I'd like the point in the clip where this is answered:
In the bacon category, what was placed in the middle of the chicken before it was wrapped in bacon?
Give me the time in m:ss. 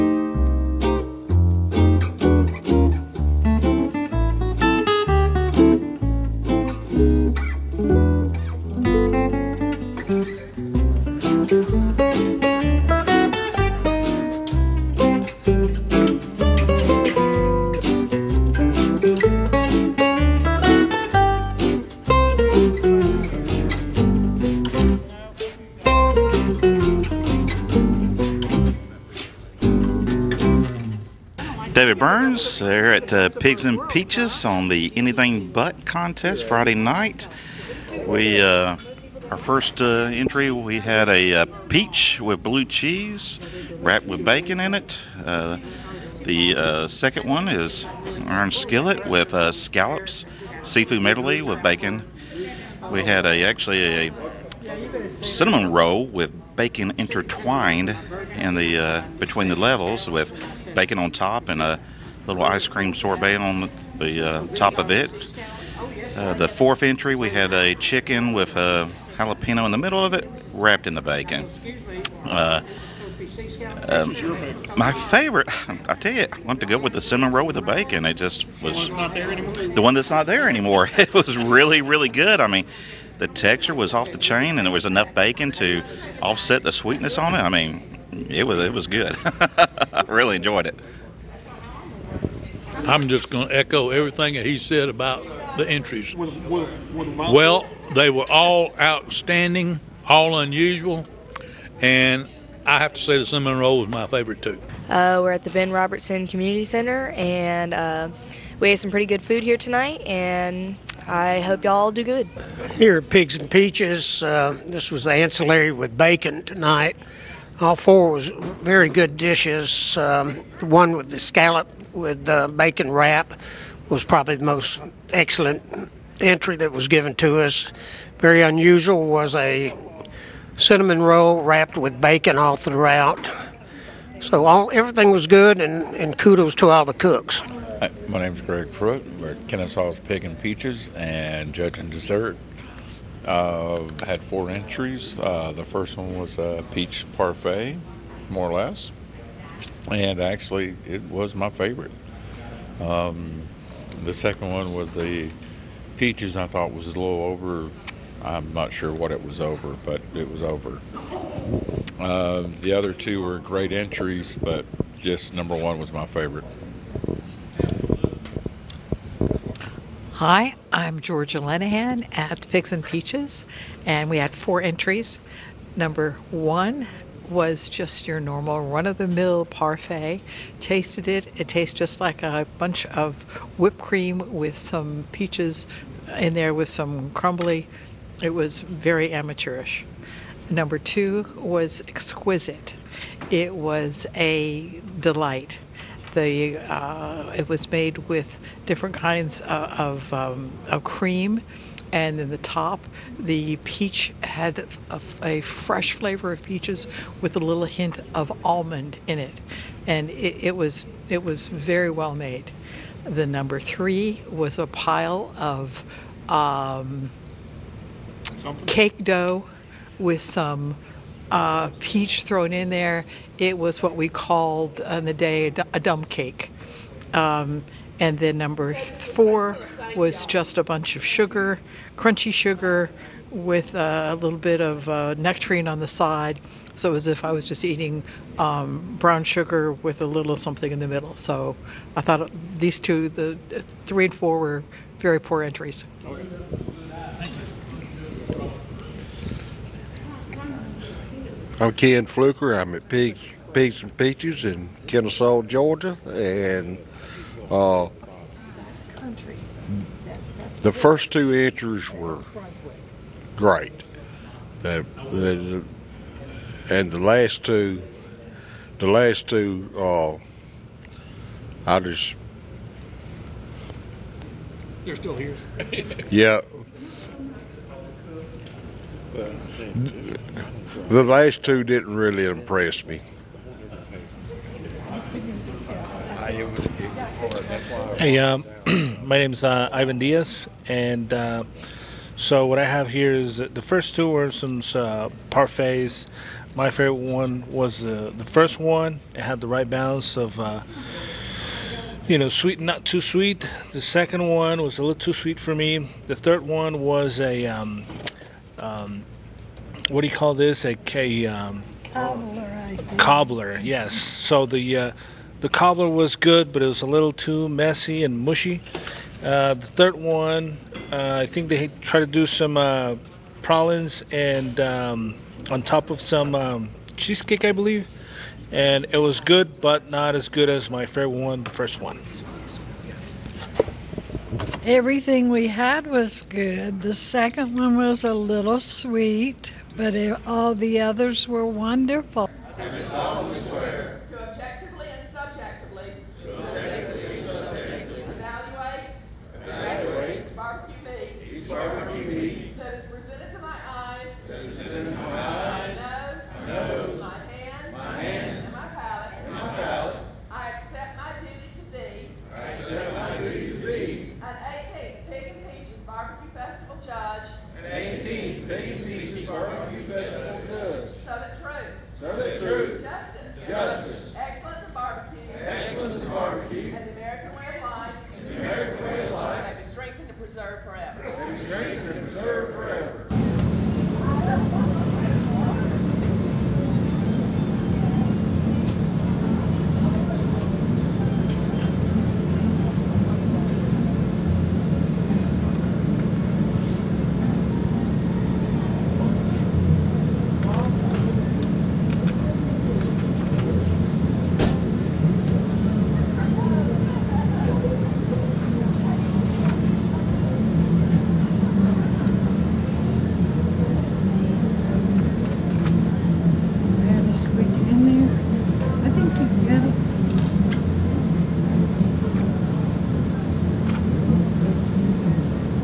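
1:09.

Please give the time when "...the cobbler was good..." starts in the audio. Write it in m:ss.
5:15.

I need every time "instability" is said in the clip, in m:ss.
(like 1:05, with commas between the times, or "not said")
not said.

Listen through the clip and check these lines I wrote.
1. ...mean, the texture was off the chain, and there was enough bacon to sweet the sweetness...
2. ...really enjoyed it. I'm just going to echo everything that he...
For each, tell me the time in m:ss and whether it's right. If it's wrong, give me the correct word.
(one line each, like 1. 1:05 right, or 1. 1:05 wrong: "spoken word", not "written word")
1. 1:22 wrong: "offset", not "sweet"
2. 1:30 right.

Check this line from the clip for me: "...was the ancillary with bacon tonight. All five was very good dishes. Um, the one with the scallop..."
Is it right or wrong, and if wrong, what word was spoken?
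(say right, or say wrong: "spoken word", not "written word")
wrong: "four", not "five".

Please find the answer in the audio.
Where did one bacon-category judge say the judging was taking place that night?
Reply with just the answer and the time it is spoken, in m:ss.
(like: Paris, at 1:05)
Ben Robertson Community Center, at 1:45.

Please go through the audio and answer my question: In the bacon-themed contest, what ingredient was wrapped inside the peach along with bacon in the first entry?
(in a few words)
blue cheese.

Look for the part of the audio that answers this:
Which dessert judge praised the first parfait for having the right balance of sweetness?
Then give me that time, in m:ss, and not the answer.
4:49.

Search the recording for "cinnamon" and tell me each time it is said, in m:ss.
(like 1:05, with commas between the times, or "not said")
0:55, 1:17, 1:43, 2:10.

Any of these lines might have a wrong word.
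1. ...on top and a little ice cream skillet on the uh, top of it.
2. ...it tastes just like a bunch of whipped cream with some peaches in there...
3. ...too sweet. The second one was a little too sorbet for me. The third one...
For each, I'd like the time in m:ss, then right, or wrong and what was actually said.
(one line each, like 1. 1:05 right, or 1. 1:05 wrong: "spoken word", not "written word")
1. 1:00 wrong: "sorbet", not "skillet"
2. 3:01 right
3. 5:02 wrong: "sweet", not "sorbet".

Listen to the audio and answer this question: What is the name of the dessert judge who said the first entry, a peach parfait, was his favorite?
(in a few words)
Greg Pruitt.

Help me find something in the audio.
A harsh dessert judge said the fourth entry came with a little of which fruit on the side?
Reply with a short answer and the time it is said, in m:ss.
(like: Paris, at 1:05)
nectarine, at 3:55.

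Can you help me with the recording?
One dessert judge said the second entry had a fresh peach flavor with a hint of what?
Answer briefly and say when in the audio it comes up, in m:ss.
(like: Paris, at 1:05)
almond, at 3:28.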